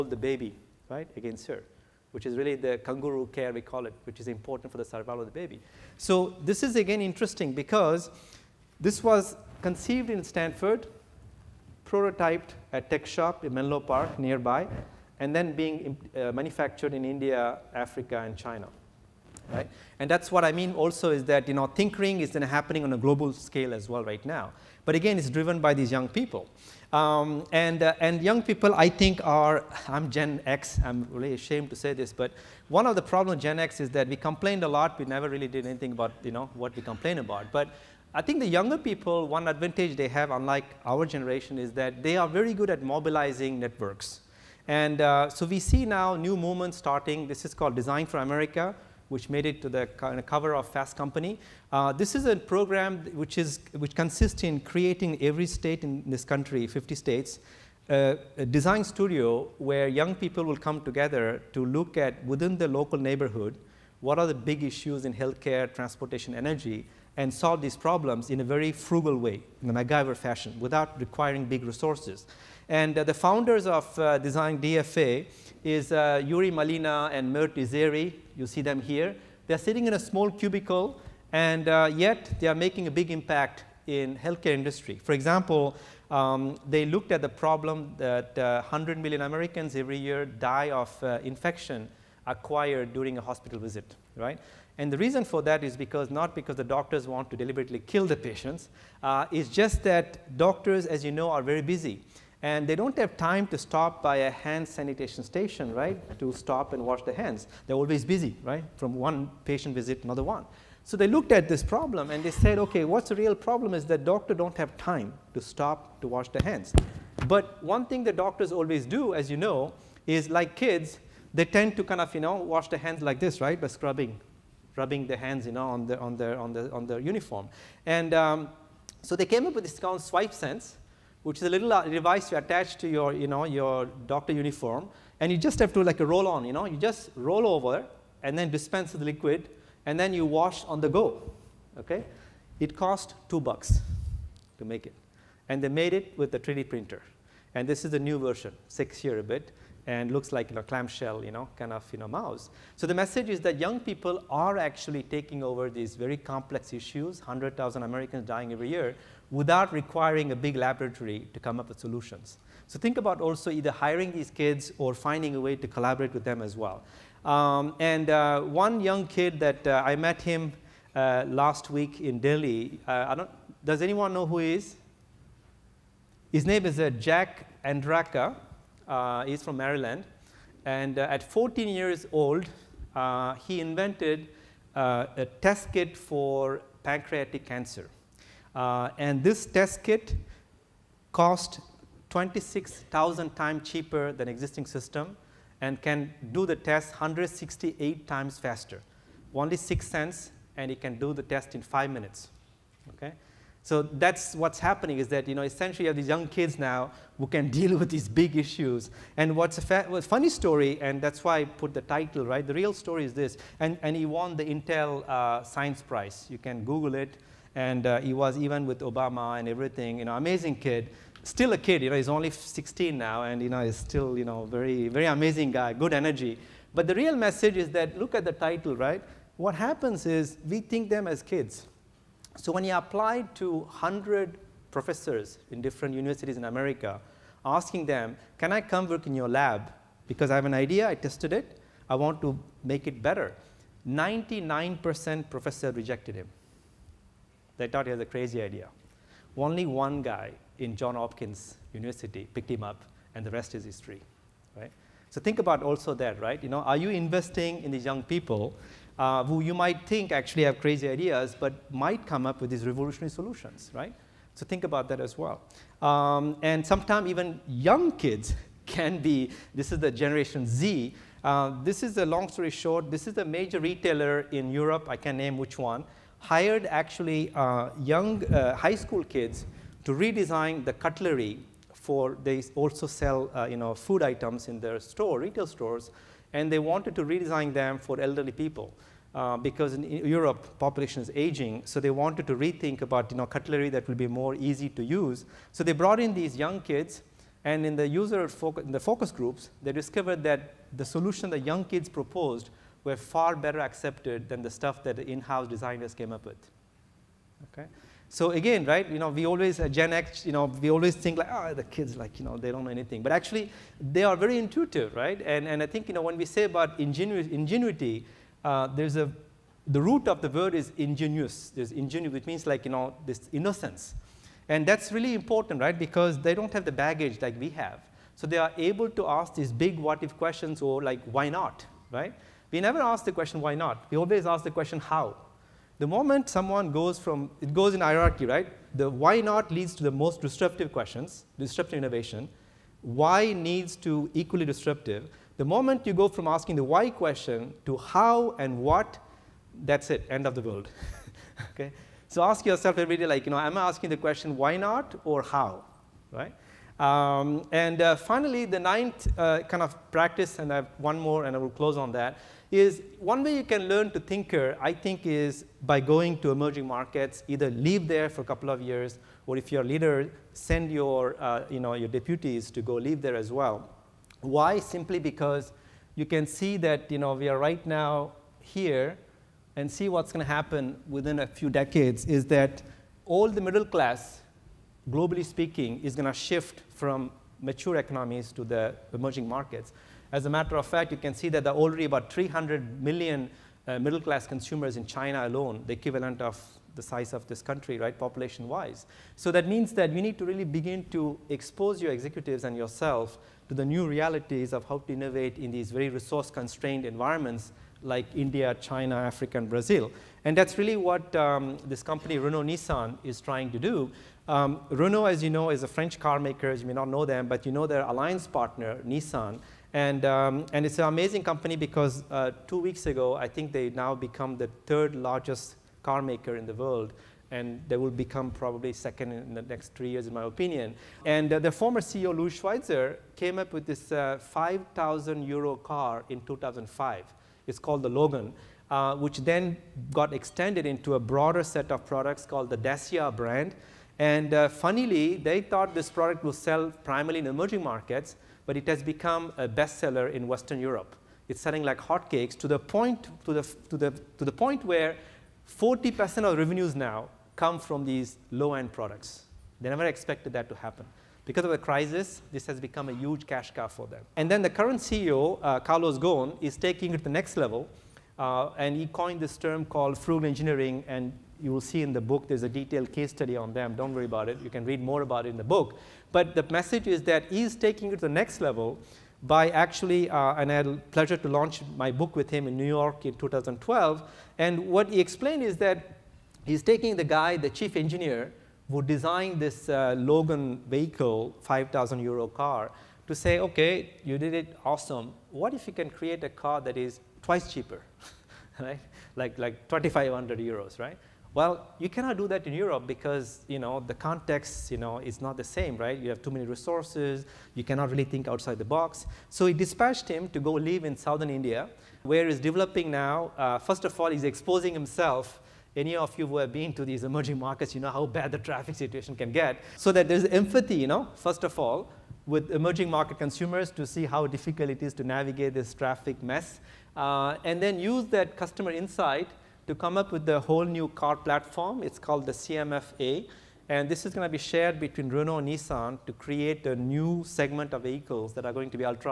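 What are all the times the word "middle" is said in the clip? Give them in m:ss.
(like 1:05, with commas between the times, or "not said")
6:23, 6:33.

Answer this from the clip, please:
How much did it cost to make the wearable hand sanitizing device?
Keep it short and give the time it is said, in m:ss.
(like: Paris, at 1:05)
2 bucks, at 2:23.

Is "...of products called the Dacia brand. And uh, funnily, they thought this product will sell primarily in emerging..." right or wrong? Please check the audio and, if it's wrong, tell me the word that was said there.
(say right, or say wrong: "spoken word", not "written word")
right.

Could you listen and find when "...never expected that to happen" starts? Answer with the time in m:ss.
7:39.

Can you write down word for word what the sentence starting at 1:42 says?
And they don't have time to stop by a hand sanitation station, right, to stop and wash their hands.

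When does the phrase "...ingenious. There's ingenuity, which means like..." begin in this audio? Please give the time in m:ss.
5:20.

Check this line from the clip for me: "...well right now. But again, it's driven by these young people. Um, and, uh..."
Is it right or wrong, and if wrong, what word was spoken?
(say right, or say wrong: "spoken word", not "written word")
right.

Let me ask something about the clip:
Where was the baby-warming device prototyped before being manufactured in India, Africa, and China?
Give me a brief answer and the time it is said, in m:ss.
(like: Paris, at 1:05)
TechShop in Menlo Park, at 0:12.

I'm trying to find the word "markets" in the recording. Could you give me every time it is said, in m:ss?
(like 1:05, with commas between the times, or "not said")
6:06, 6:29, 7:27, 8:37, 8:42.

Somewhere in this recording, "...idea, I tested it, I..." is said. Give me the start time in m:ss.
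4:00.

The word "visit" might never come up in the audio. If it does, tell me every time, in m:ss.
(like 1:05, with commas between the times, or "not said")
1:33, 1:49.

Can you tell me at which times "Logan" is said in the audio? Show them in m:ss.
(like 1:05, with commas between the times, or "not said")
7:17, 8:09.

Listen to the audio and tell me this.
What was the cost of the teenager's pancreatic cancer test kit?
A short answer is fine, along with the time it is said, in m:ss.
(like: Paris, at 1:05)
6 cents, at 3:19.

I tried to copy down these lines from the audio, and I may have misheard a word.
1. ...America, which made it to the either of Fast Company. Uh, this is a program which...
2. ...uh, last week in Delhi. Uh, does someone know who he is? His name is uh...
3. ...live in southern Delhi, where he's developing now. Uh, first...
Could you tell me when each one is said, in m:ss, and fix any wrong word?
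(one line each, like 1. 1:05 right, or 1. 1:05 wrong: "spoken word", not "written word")
1. 0:48 wrong: "cover", not "either"
2. 2:50 wrong: "anyone", not "someone"
3. 8:30 wrong: "India", not "Delhi".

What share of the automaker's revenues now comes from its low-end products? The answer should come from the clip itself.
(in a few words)
40%.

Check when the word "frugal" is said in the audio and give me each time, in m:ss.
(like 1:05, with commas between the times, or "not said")
1:08, 7:49.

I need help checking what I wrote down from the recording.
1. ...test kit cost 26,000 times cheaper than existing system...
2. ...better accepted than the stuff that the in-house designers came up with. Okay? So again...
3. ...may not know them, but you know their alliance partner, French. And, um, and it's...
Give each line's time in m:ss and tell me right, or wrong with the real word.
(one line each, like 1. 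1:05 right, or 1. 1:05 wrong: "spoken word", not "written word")
1. 3:09 right
2. 5:03 right
3. 6:56 wrong: "Nissan", not "French".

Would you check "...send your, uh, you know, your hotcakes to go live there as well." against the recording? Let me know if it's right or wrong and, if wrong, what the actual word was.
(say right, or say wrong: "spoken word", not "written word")
wrong: "deputies", not "hotcakes".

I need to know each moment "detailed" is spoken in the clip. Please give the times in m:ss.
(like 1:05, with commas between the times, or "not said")
7:52.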